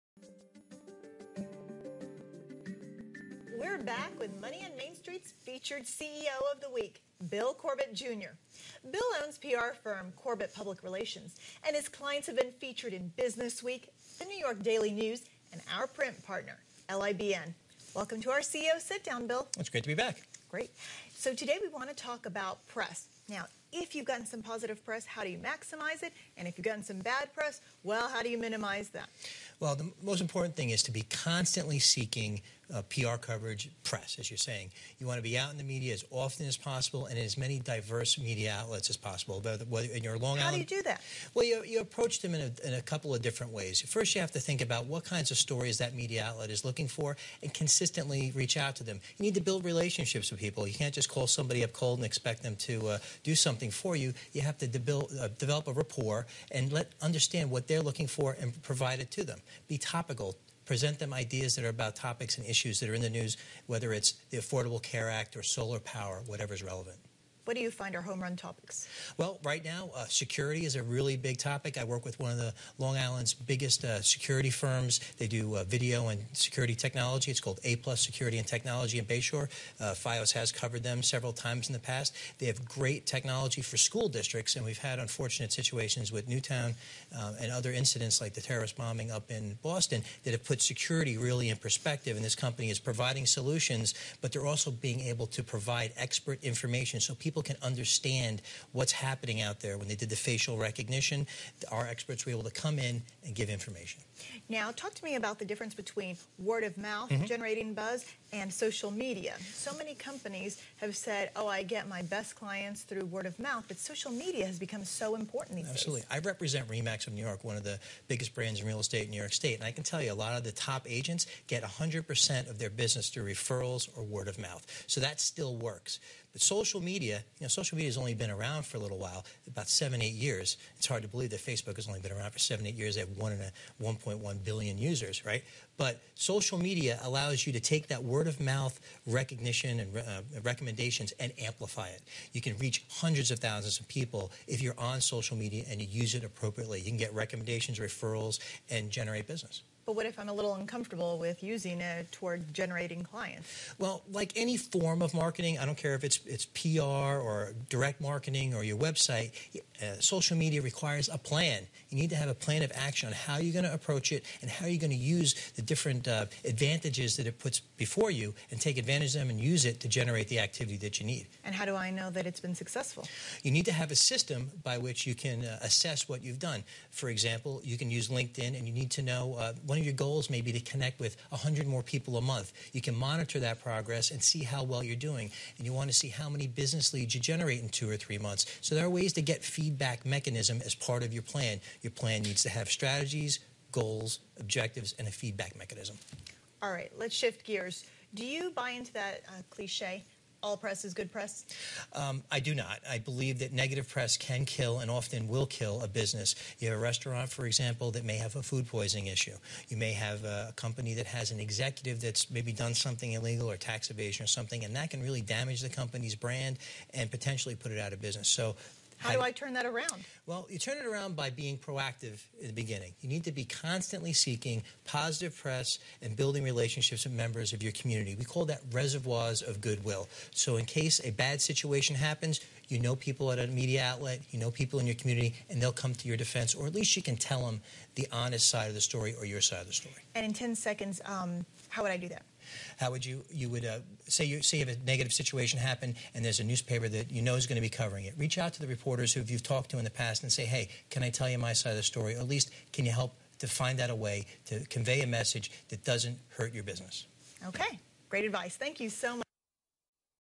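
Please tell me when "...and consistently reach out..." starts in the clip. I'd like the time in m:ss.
0:47.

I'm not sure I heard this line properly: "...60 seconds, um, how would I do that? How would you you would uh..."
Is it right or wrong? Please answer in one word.
wrong.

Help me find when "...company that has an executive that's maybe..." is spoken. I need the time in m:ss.
3:30.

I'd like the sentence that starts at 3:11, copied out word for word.
Your plan needs to have strategies, goals, objectives, and a feedback mechanism.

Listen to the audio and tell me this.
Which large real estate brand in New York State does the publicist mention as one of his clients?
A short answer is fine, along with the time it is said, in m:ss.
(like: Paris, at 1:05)
Remax of New York, at 1:56.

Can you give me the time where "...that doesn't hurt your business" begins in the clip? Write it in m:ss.
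4:15.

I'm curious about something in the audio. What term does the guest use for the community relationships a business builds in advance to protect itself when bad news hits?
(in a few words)
Reservoirs of goodwill.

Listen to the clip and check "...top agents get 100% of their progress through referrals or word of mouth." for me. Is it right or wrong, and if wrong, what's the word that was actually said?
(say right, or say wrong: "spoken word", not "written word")
wrong: "business", not "progress".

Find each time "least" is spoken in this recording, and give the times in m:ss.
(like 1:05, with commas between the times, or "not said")
3:56, 4:12.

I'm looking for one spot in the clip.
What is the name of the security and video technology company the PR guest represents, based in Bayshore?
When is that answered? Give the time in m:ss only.
1:17.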